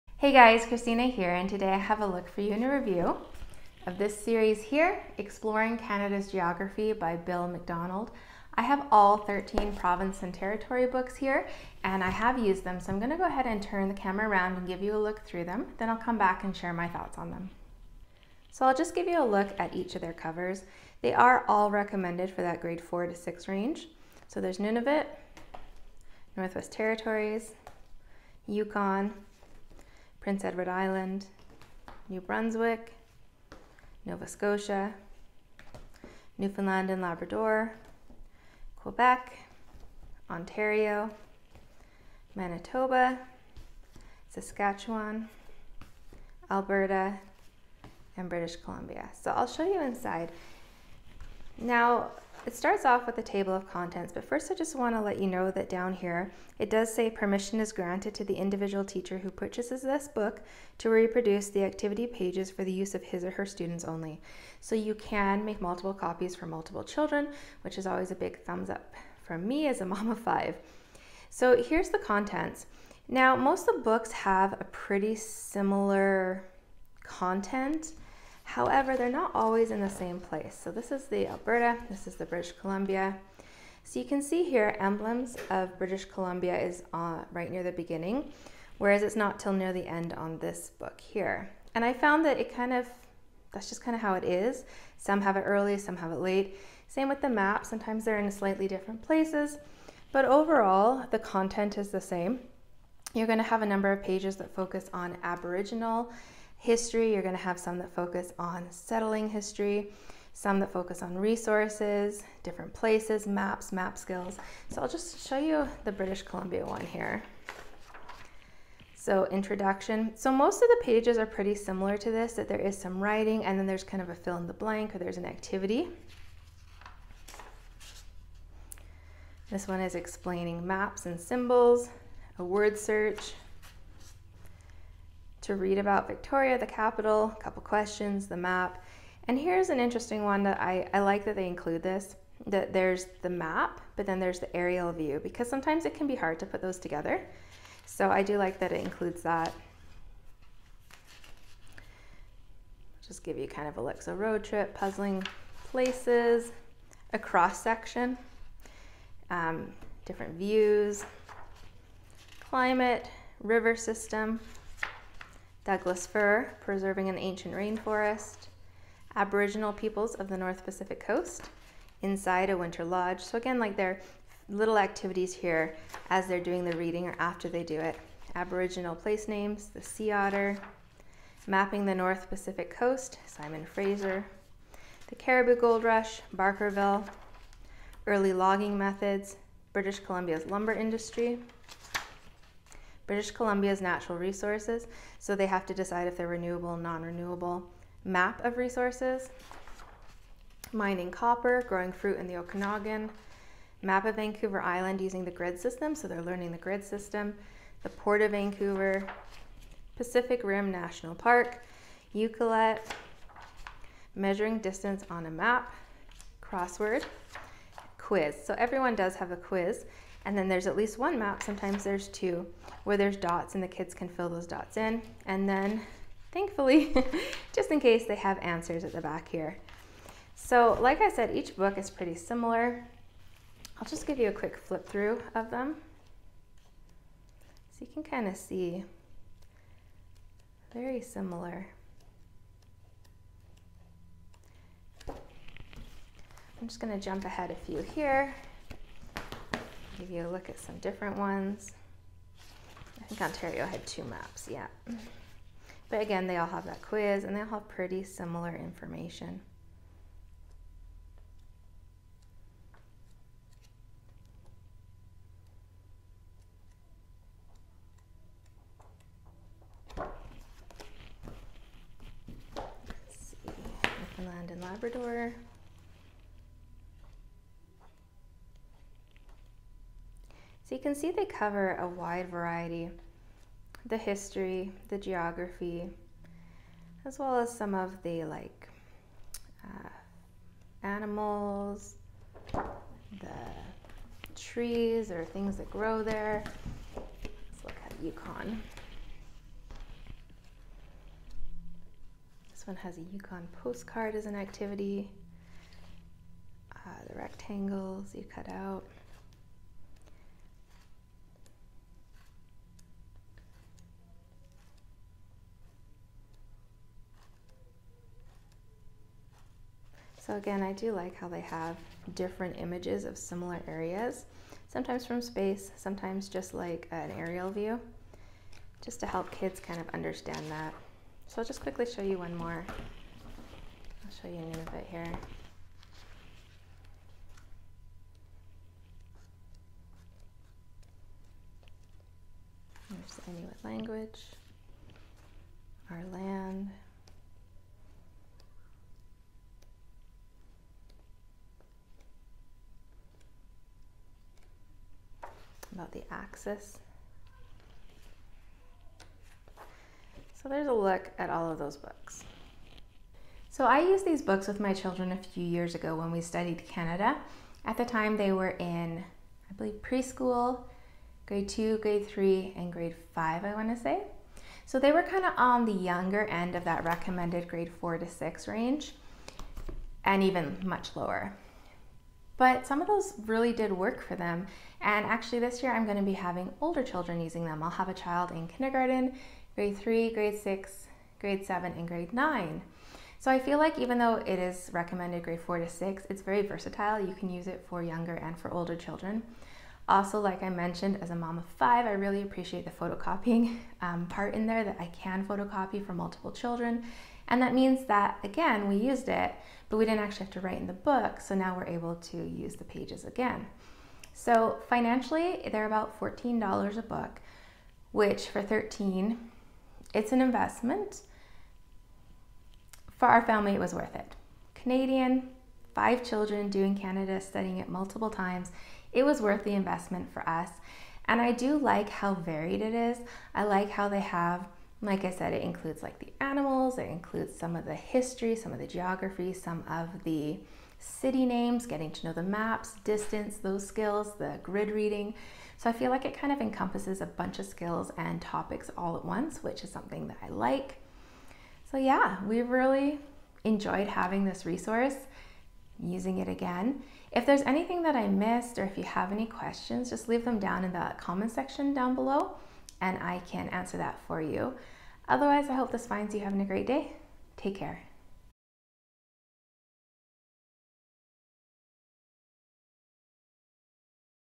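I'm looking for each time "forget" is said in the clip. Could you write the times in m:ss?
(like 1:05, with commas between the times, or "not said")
not said.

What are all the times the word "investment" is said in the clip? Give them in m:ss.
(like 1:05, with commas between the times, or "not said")
7:00, 7:09.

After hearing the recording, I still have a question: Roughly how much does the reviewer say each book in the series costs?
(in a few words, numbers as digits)
$14.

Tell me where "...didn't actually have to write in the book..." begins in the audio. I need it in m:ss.
6:49.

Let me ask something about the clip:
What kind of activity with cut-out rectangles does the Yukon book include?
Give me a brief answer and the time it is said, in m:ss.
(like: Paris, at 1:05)
Yukon postcard, at 5:03.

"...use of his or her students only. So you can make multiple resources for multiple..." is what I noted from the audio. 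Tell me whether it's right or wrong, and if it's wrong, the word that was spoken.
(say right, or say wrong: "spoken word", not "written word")
wrong: "copies", not "resources".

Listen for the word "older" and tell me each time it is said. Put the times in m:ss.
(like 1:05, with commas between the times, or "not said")
6:26, 6:38.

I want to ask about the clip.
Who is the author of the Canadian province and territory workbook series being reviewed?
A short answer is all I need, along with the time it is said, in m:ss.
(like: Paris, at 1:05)
Bill McDonald, at 0:07.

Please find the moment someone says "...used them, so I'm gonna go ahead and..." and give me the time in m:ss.
0:12.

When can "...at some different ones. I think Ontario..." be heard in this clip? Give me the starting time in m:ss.
4:10.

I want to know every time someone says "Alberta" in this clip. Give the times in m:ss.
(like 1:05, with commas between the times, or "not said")
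0:46, 1:21.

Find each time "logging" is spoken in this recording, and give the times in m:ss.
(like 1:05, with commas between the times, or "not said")
3:08.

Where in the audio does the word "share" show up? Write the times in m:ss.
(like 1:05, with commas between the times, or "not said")
0:16.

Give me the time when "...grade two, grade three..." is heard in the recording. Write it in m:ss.
6:11.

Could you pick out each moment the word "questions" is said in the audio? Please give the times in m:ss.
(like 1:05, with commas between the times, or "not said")
2:17, 7:39.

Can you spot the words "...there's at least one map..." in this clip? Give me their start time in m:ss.
3:40.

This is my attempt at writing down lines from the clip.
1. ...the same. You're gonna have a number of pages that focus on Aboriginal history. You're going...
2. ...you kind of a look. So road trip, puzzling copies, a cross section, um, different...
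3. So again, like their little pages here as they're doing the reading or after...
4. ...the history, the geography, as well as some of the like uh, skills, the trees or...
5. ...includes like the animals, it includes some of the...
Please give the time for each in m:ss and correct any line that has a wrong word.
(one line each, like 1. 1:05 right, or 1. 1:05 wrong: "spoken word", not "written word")
1. 1:41 right
2. 2:33 wrong: "places", not "copies"
3. 2:53 wrong: "activities", not "pages"
4. 4:43 wrong: "animals", not "skills"
5. 7:15 right.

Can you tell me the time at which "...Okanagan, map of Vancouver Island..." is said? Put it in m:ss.
3:22.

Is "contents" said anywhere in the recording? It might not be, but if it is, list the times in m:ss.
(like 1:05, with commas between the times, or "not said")
0:53, 1:11, 1:17, 1:41.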